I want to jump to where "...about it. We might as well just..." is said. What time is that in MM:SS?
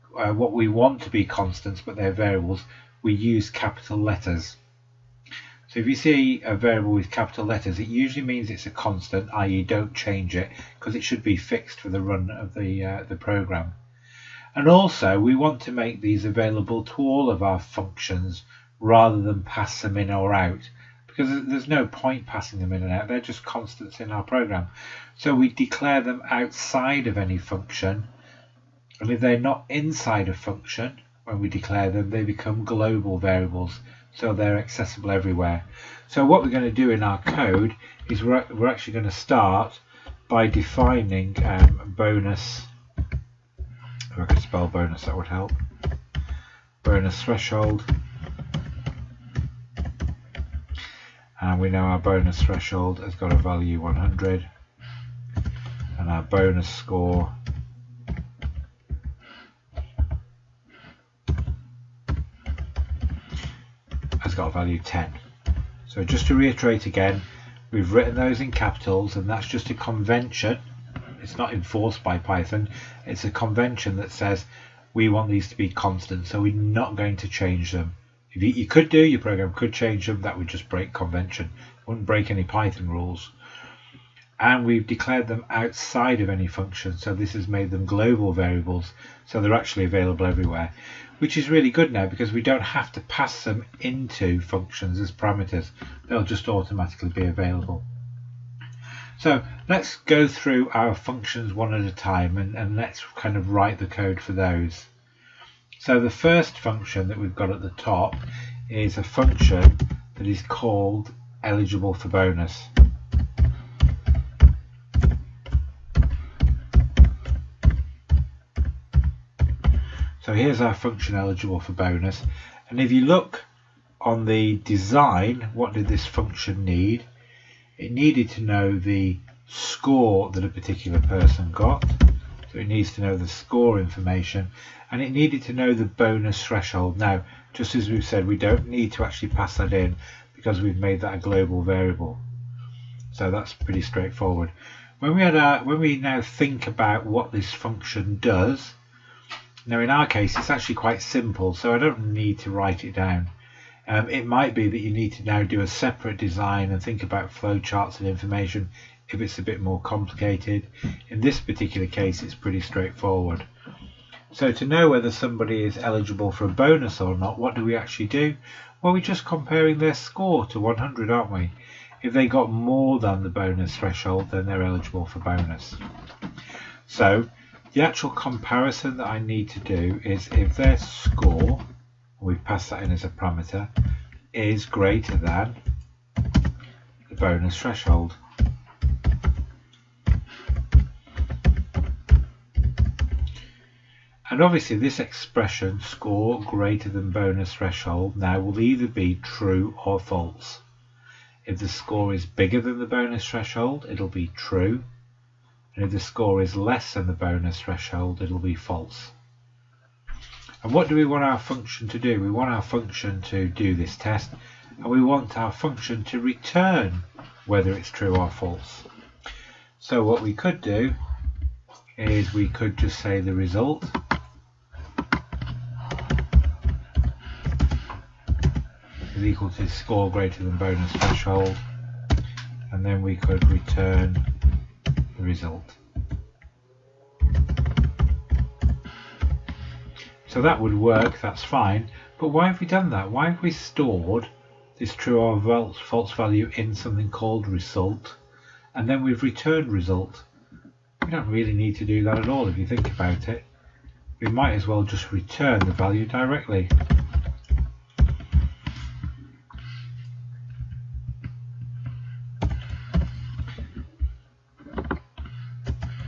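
04:12.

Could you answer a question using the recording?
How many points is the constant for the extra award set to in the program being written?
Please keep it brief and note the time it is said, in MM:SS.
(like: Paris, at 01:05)
10, at 01:04.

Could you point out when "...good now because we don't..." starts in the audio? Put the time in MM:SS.
01:31.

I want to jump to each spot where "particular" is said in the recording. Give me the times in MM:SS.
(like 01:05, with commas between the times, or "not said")
02:10, 02:41.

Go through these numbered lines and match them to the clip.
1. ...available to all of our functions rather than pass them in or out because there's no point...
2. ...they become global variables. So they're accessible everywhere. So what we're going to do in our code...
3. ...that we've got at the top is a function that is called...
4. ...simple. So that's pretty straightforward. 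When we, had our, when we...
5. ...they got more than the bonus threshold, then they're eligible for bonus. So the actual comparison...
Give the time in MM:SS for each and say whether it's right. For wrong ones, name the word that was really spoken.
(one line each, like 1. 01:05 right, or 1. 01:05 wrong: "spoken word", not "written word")
1. 00:16 right
2. 00:32 right
3. 01:47 right
4. 02:21 wrong: "variable", not "simple"
5. 02:52 right.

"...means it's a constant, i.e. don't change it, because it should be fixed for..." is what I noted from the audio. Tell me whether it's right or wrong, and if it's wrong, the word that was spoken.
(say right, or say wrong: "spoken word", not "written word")
right.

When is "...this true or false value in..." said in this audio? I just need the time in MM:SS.
04:04.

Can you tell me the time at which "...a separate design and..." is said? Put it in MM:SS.
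02:35.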